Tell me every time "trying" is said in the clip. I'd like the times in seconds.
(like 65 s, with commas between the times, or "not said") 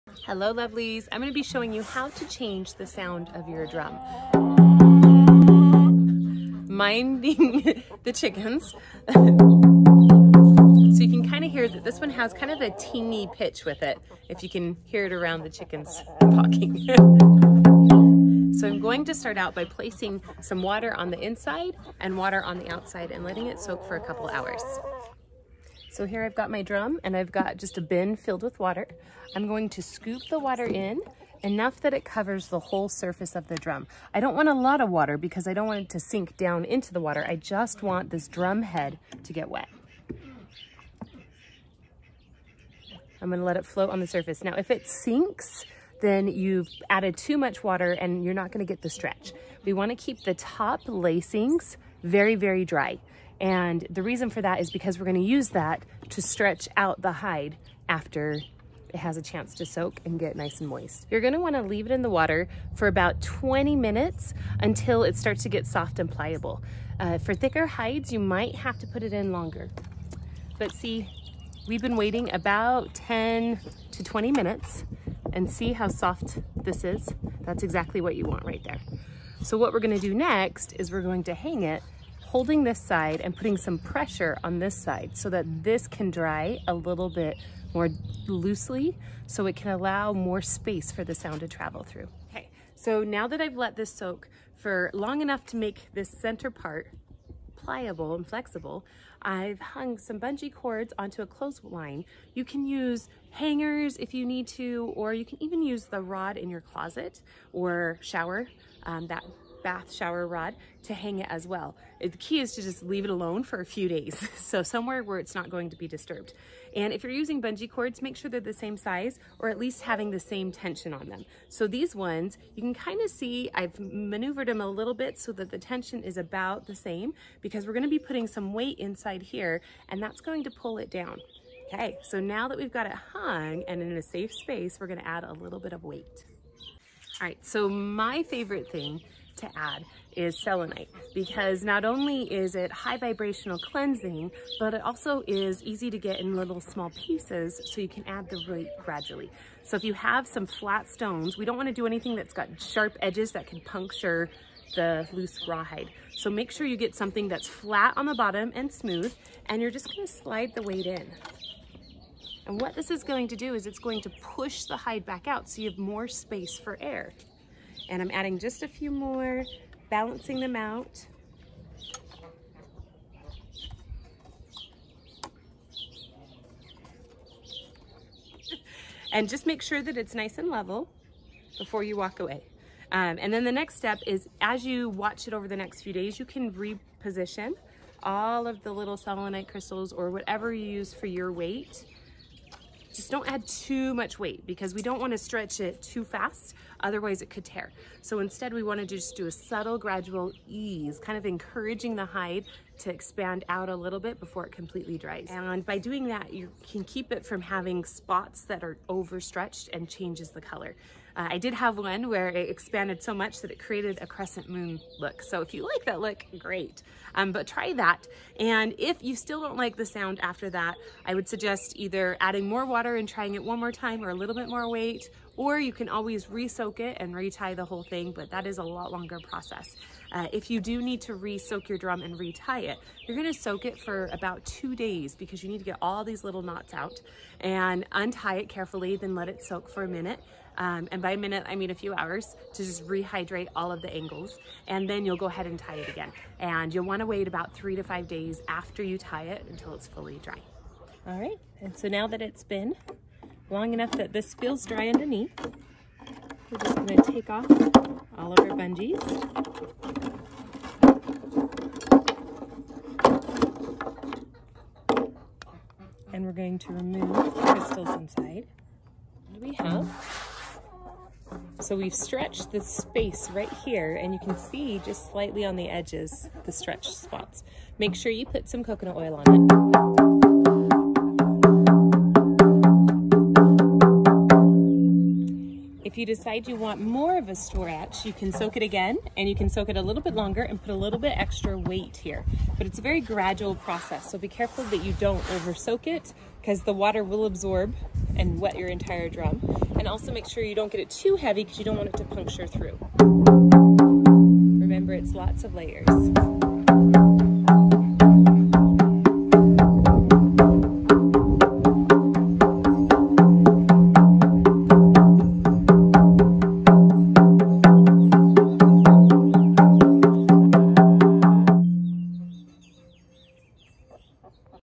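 223 s.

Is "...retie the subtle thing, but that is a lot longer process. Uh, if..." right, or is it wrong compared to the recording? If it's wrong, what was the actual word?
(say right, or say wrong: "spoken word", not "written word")
wrong: "whole", not "subtle".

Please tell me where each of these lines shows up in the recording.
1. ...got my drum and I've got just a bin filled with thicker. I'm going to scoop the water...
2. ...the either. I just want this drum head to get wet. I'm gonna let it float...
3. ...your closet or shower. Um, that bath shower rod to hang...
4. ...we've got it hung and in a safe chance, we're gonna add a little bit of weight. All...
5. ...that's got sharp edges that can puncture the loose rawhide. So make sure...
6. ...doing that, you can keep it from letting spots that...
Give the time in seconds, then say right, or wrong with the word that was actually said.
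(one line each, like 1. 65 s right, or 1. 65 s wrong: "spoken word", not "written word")
1. 26 s wrong: "water", not "thicker"
2. 36 s wrong: "water", not "either"
3. 106 s right
4. 132 s wrong: "space", not "chance"
5. 152 s right
6. 205 s wrong: "having", not "letting".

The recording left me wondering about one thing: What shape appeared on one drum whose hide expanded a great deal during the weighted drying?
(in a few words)
crescent moon.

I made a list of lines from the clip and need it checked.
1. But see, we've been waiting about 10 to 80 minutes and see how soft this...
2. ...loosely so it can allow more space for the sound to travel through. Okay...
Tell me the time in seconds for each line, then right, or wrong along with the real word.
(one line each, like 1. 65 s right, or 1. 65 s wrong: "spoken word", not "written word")
1. 70 s wrong: "20", not "80"
2. 88 s right.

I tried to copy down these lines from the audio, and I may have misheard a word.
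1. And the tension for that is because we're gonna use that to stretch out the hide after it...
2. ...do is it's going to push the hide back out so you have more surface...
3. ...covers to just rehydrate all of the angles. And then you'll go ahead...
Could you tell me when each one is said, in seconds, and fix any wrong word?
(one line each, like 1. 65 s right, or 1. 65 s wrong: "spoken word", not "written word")
1. 53 s wrong: "reason", not "tension"
2. 163 s wrong: "space", not "surface"
3. 241 s wrong: "hours", not "covers".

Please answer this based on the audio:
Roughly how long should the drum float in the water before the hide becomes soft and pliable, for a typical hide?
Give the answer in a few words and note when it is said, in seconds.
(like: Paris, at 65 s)
20 minutes, at 62 s.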